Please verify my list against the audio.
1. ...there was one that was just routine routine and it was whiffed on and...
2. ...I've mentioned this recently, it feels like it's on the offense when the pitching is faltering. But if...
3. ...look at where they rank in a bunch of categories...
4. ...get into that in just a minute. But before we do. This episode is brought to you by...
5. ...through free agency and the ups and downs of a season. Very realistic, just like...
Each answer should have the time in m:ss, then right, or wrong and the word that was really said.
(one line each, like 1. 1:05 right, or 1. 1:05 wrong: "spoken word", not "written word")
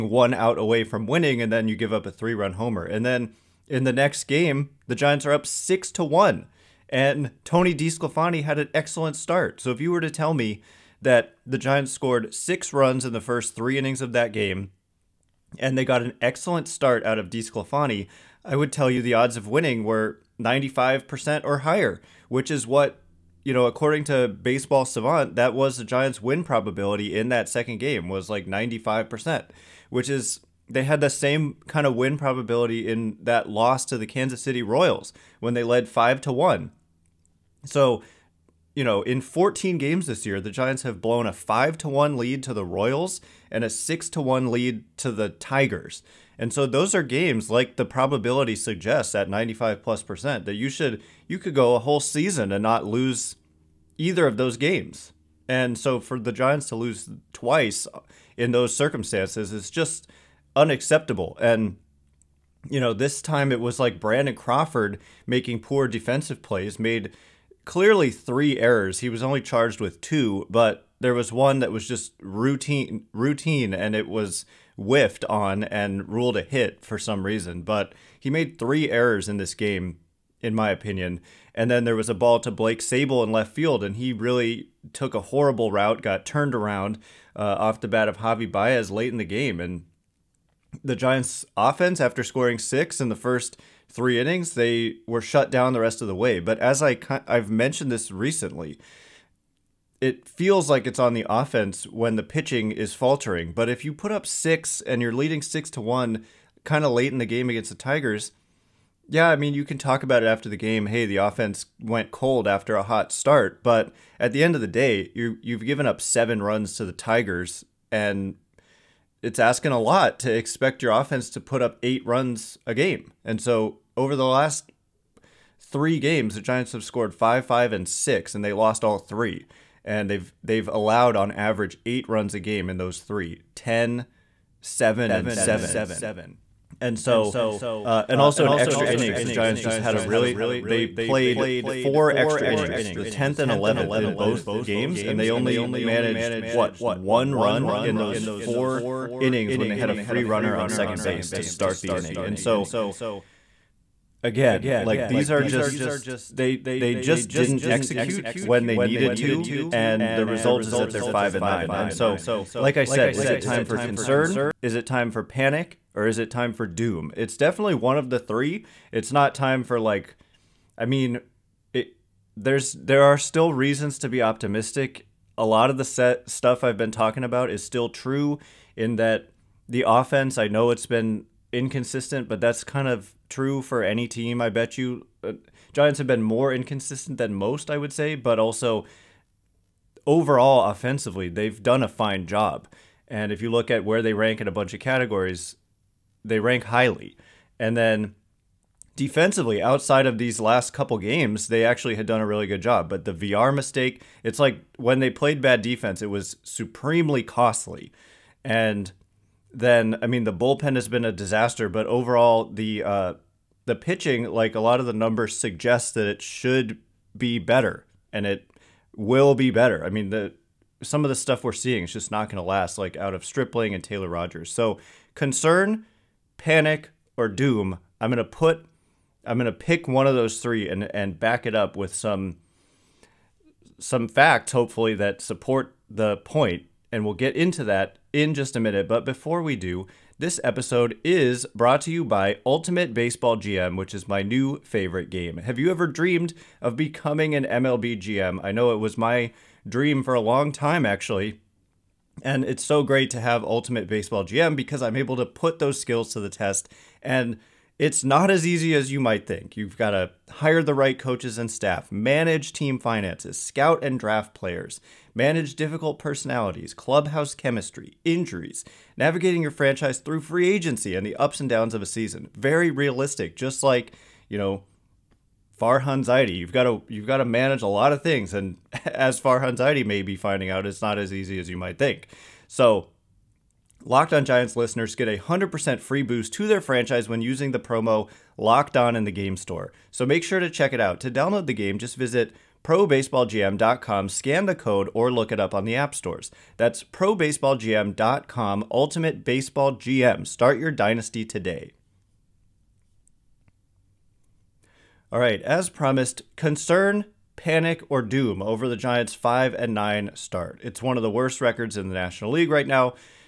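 1. 1:10 right
2. 1:37 right
3. 3:13 right
4. 3:57 right
5. 4:29 right.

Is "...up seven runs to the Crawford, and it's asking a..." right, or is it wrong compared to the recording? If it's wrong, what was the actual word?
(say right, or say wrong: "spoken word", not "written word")
wrong: "Tigers", not "Crawford".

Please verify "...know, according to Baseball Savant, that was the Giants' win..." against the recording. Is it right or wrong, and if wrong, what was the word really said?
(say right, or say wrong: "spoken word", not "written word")
right.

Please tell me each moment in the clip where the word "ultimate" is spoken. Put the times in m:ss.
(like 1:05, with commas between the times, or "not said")
4:02, 4:13, 4:58.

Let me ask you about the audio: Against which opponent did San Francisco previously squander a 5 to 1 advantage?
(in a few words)
Kansas City Royals.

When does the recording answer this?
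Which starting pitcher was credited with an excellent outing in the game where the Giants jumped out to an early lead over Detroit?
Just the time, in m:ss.
0:07.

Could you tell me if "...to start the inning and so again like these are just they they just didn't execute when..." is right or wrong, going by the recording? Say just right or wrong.
right.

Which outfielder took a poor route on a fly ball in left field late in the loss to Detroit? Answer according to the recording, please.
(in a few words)
Blake Sabol.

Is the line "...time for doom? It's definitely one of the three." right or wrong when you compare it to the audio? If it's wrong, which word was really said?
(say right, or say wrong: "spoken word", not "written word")
right.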